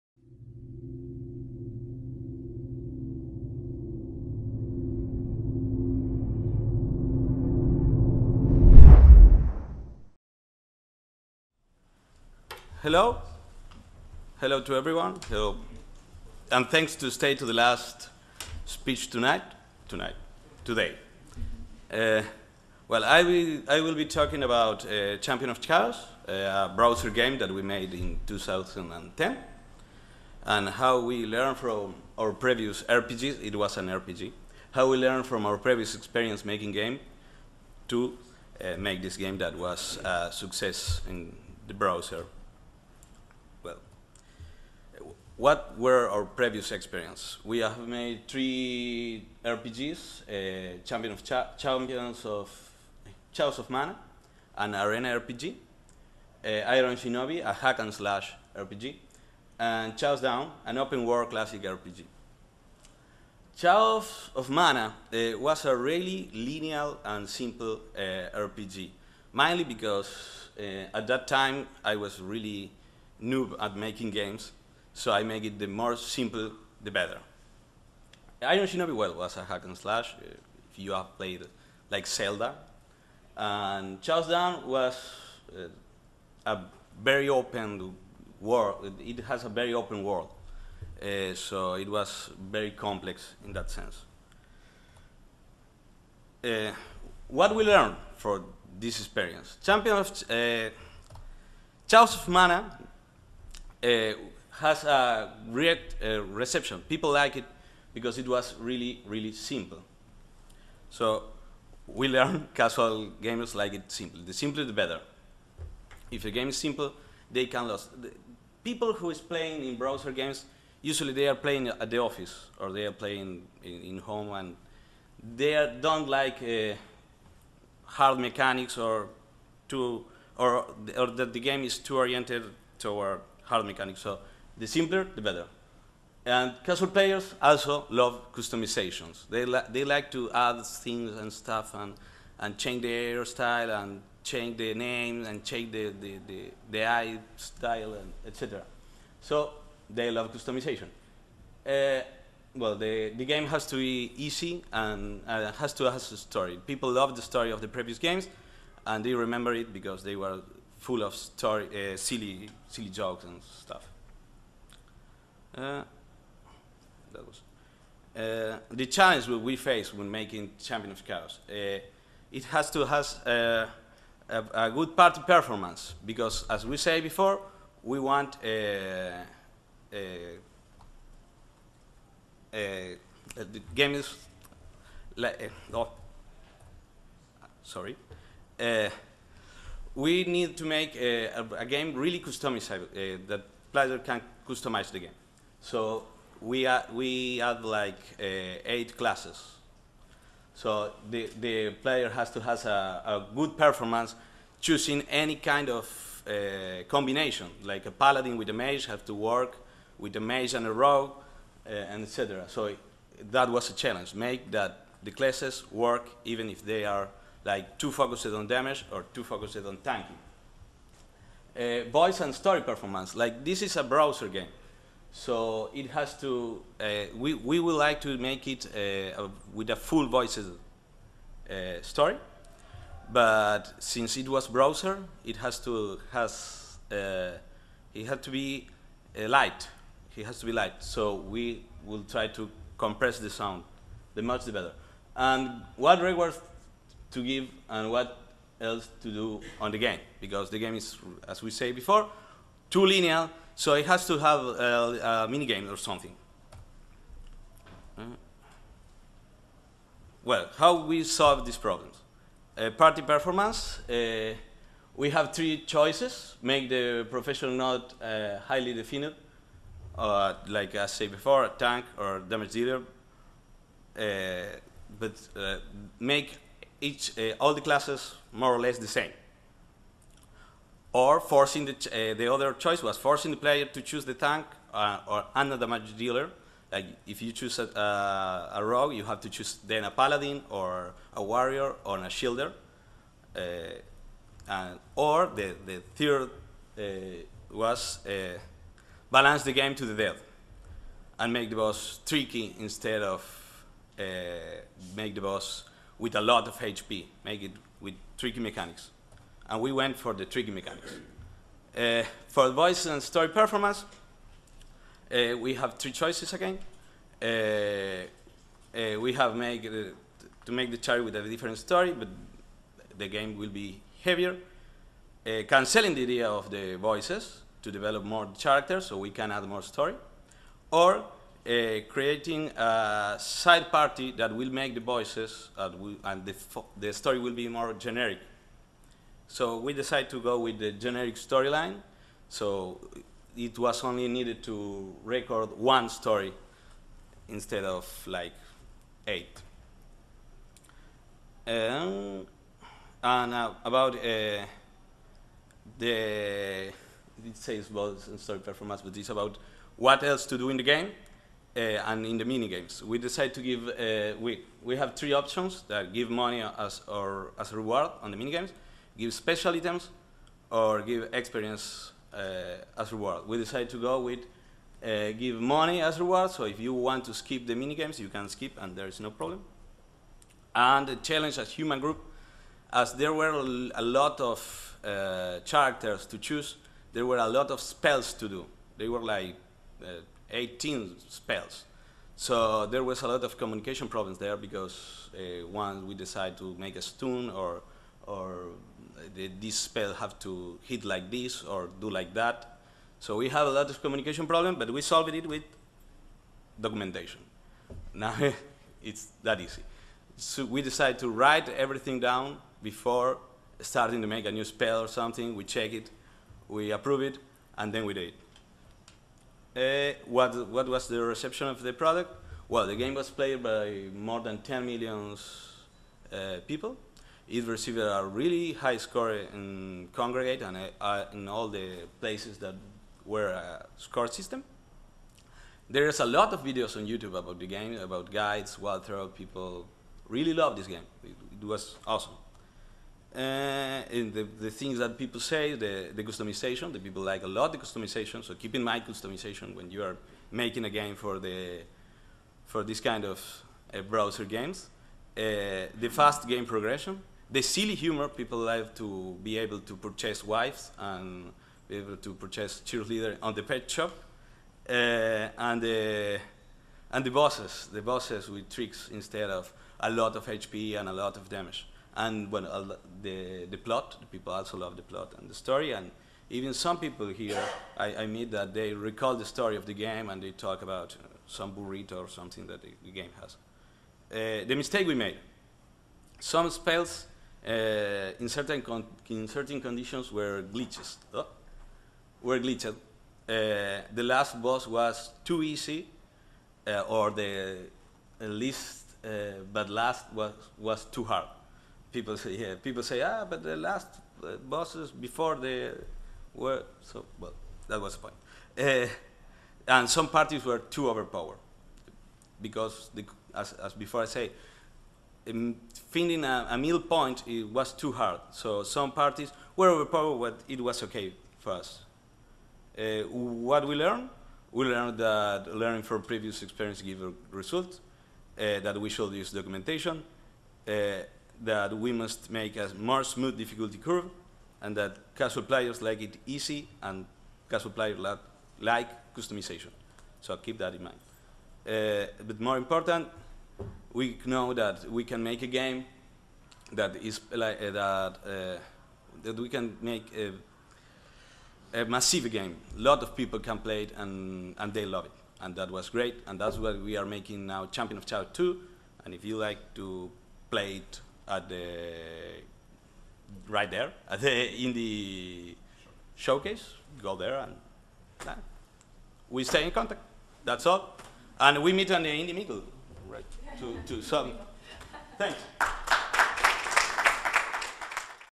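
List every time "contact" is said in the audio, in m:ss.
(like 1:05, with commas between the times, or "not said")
9:29.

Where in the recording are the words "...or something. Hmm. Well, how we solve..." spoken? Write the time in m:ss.
4:15.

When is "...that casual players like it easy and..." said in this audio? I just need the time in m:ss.
8:54.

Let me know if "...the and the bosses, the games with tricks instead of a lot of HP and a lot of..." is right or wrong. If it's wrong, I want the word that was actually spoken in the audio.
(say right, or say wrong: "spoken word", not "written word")
wrong: "bosses", not "games".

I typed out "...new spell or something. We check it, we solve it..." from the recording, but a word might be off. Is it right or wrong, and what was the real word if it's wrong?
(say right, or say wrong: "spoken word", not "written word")
wrong: "approve", not "solve".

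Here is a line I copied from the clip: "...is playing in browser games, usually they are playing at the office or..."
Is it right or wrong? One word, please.
right.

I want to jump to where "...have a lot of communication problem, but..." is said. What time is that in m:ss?
6:43.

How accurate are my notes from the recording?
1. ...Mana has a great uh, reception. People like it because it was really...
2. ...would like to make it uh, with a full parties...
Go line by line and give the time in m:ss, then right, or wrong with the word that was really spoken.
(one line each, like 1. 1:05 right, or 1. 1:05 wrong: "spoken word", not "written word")
1. 1:42 right
2. 3:47 wrong: "voices", not "parties".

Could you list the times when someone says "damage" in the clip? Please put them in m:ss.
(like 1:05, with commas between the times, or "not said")
3:38, 4:32, 4:45, 7:51.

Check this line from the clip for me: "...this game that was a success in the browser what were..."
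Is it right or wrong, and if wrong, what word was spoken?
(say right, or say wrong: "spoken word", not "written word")
right.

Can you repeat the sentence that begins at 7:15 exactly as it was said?
There's a lot of videos on YouTube about the game, about guides, wild throw.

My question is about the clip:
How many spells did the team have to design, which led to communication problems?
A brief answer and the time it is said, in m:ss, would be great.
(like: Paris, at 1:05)
18, at 6:30.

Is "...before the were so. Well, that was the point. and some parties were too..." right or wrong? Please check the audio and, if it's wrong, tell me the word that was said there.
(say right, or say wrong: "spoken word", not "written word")
right.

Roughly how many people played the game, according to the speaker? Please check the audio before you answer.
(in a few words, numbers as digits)
More than 10 million.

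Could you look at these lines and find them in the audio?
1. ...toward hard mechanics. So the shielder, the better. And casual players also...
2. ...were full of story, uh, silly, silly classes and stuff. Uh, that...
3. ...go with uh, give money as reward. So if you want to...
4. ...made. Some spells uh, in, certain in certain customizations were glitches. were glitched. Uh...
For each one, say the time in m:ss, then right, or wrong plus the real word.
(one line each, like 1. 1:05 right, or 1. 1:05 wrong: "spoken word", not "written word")
1. 2:12 wrong: "simpler", not "shielder"
2. 2:40 wrong: "jokes", not "classes"
3. 6:13 right
4. 8:04 wrong: "conditions", not "customizations".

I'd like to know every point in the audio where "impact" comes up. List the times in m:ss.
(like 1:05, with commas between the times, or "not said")
not said.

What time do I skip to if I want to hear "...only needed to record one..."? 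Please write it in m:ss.
5:43.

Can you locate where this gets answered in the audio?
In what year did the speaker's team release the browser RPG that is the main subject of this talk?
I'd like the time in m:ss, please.
0:28.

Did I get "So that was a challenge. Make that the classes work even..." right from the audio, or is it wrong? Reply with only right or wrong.
right.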